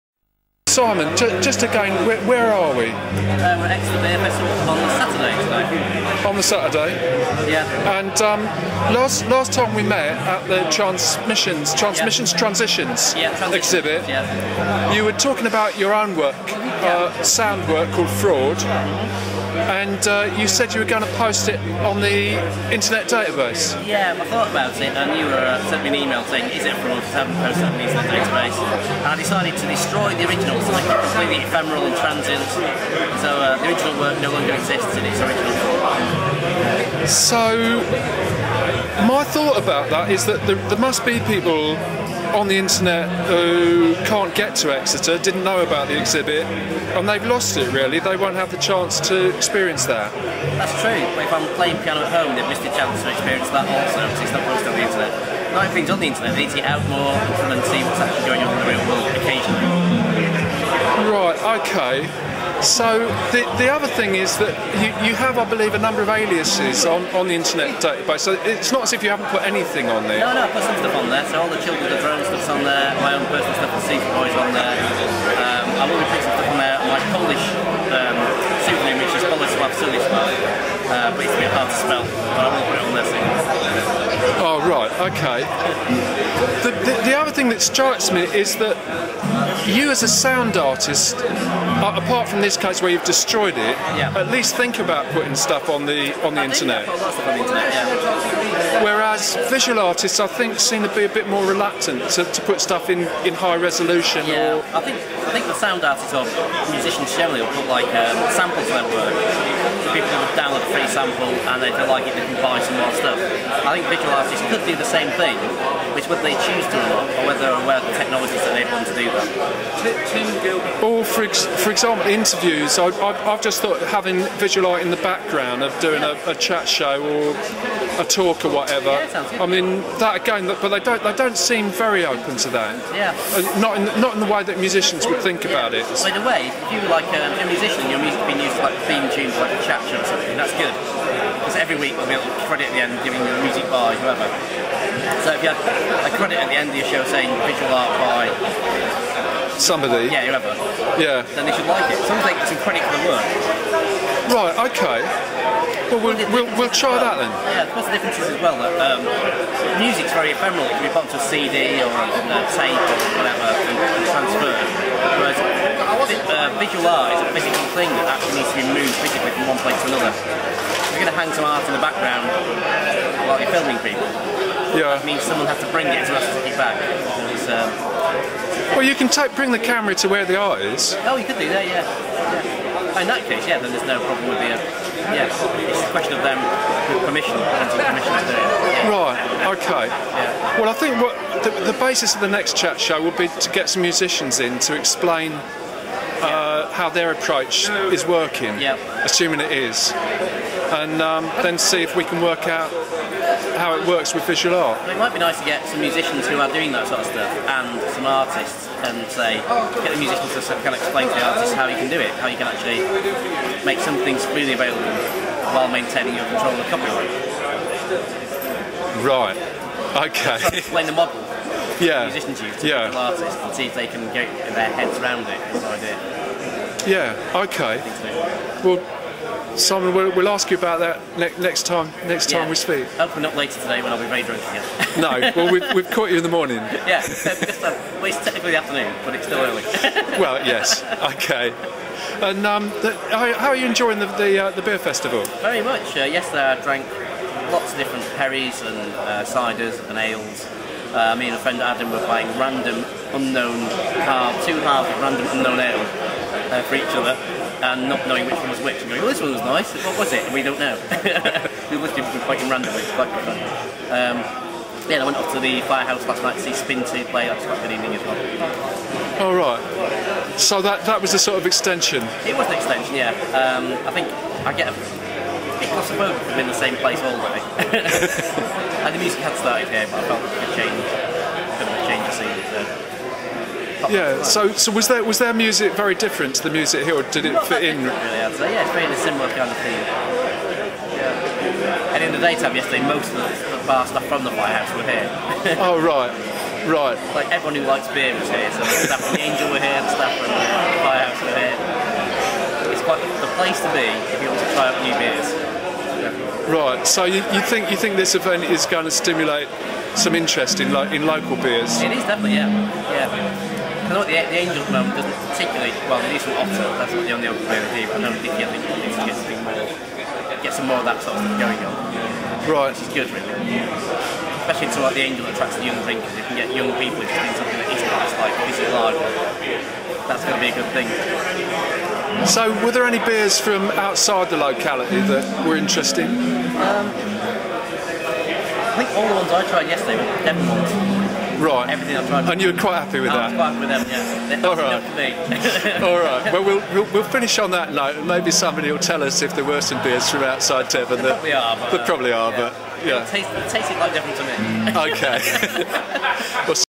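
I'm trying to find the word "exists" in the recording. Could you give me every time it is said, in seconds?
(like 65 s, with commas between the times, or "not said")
34 s.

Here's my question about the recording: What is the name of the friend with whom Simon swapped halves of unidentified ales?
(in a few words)
Adam.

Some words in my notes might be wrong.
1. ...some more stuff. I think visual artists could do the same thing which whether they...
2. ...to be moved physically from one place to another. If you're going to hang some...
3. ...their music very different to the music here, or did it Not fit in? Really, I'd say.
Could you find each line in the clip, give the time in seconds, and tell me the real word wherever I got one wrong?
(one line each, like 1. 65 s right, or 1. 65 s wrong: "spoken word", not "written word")
1. 112 s right
2. 168 s right
3. 285 s right.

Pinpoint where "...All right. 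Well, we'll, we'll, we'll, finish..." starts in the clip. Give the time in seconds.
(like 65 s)
345 s.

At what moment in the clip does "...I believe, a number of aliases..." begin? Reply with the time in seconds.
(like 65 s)
65 s.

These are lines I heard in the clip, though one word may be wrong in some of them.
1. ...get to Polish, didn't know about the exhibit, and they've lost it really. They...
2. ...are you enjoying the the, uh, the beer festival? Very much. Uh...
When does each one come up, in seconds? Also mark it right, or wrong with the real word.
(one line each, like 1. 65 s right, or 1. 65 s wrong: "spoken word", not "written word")
1. 44 s wrong: "Exeter", not "Polish"
2. 243 s right.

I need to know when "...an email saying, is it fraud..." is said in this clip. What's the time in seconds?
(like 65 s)
25 s.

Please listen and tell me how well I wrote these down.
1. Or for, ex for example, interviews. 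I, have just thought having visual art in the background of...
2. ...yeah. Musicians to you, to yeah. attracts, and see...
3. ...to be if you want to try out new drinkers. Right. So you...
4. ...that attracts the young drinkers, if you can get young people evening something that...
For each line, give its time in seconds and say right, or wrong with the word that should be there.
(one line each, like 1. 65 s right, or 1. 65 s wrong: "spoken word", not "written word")
1. 120 s right
2. 221 s wrong: "artists", not "attracts"
3. 303 s wrong: "beers", not "drinkers"
4. 325 s wrong: "drinking", not "evening".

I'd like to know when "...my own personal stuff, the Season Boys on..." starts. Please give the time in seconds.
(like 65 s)
73 s.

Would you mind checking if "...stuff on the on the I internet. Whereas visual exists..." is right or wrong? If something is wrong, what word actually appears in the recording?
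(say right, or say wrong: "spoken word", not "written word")
wrong: "artists", not "exists".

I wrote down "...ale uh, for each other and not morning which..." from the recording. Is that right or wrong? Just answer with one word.
wrong.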